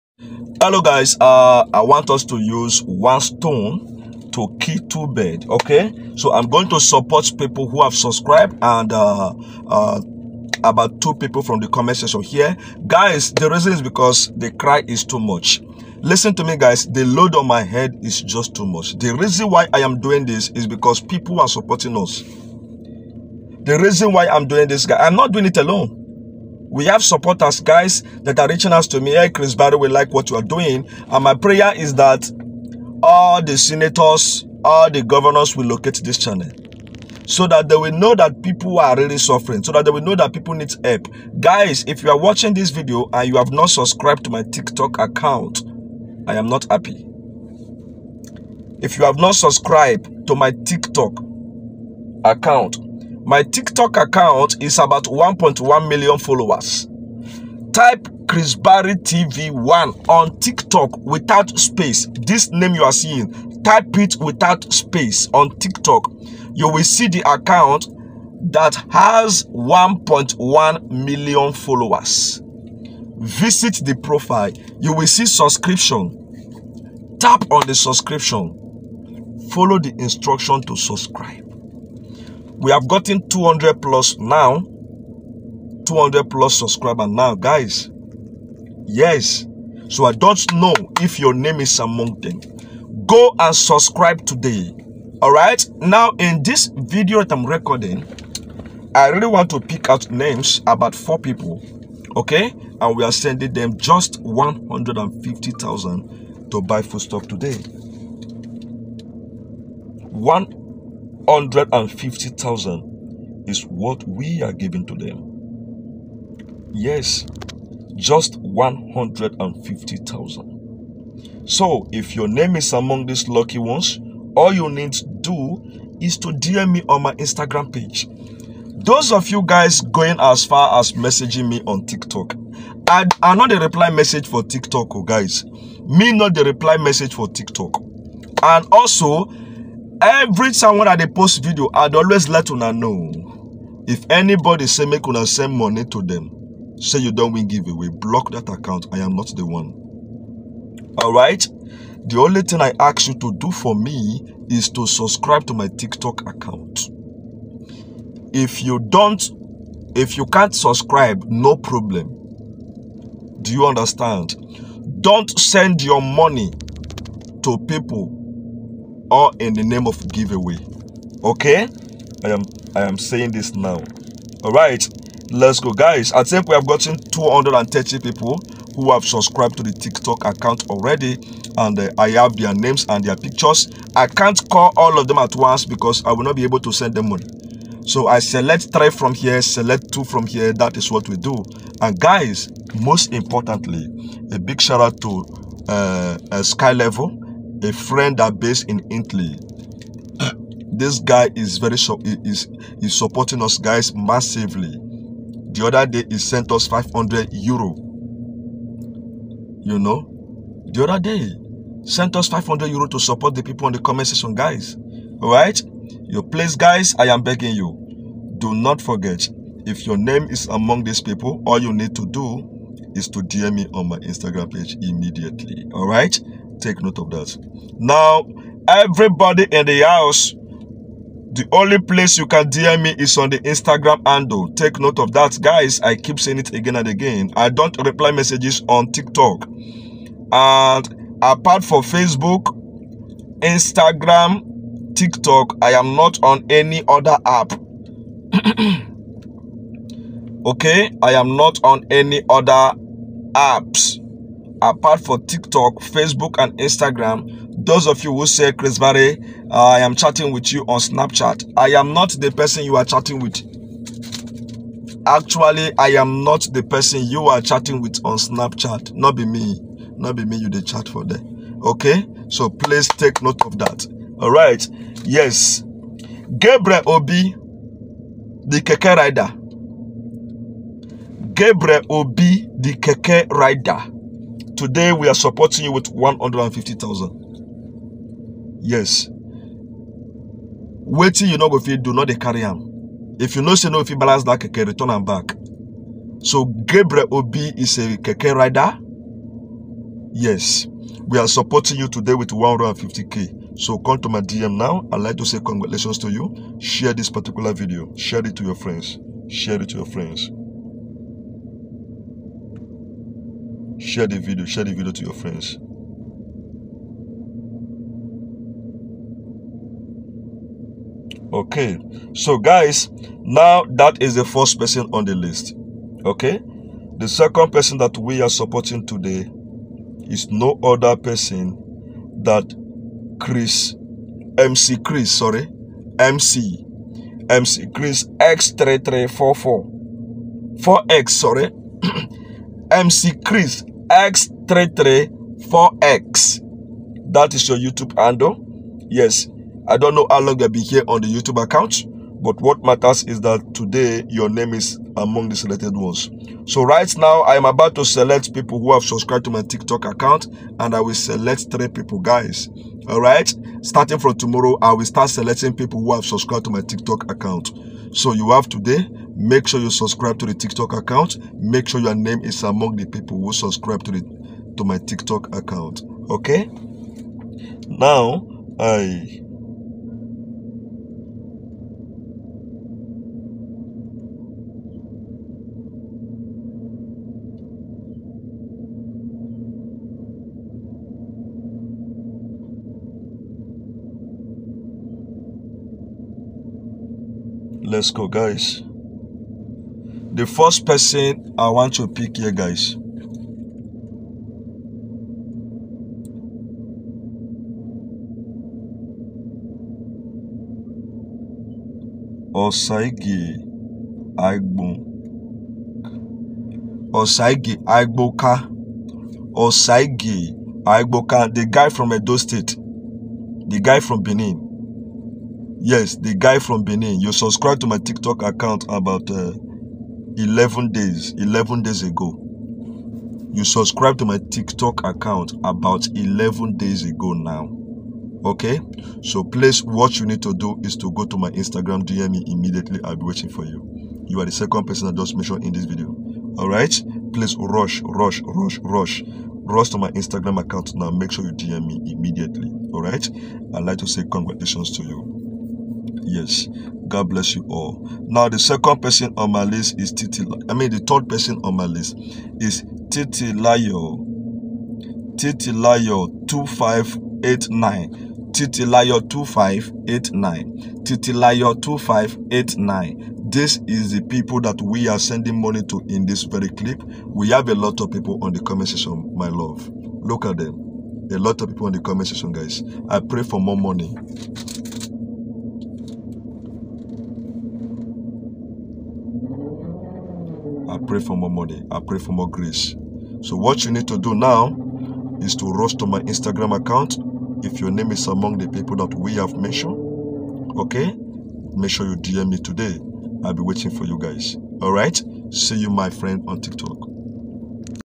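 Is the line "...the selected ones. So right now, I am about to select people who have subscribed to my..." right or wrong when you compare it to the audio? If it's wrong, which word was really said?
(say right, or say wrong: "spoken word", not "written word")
right.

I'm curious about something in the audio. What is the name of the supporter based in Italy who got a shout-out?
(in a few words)
Sky Level.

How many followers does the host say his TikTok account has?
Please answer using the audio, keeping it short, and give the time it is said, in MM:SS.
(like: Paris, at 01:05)
1.1 million, at 00:55.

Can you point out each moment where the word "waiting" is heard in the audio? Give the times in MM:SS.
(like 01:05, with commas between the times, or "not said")
04:49, 07:23, 08:23.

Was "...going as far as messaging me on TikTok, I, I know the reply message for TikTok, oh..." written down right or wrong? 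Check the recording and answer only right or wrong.
right.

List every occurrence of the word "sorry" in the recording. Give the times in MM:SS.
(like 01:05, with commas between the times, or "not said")
05:35, 05:41.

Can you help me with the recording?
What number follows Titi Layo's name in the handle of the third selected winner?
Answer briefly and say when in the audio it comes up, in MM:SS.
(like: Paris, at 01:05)
2589, at 07:45.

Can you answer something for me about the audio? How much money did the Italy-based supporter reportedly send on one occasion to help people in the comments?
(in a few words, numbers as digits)
500 euro.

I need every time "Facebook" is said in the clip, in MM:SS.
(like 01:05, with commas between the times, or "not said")
04:01, 04:15.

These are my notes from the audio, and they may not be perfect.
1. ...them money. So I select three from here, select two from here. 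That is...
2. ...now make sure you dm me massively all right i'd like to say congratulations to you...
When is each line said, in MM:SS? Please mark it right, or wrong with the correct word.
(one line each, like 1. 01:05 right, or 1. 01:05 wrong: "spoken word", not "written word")
1. 03:06 right
2. 07:30 wrong: "immediately", not "massively".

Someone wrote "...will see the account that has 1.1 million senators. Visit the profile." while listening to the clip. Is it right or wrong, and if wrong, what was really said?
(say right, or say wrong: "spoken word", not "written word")
wrong: "followers", not "senators".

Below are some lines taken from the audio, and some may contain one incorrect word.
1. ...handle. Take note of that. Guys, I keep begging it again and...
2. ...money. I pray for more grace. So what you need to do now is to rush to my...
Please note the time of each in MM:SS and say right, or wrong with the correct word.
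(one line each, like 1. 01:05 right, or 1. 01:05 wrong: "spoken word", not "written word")
1. 03:54 wrong: "saying", not "begging"
2. 08:11 right.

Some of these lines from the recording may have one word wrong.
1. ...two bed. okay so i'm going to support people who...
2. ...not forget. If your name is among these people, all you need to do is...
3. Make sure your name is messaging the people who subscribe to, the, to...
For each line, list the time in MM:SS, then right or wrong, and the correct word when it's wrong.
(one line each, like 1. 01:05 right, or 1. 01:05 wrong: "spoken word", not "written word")
1. 00:04 right
2. 03:38 right
3. 06:11 wrong: "among", not "messaging".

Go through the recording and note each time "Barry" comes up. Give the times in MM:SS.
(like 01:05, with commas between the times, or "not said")
00:29, 00:58, 04:18.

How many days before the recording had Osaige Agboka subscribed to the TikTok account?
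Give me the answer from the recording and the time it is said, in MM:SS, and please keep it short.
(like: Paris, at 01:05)
11, at 07:10.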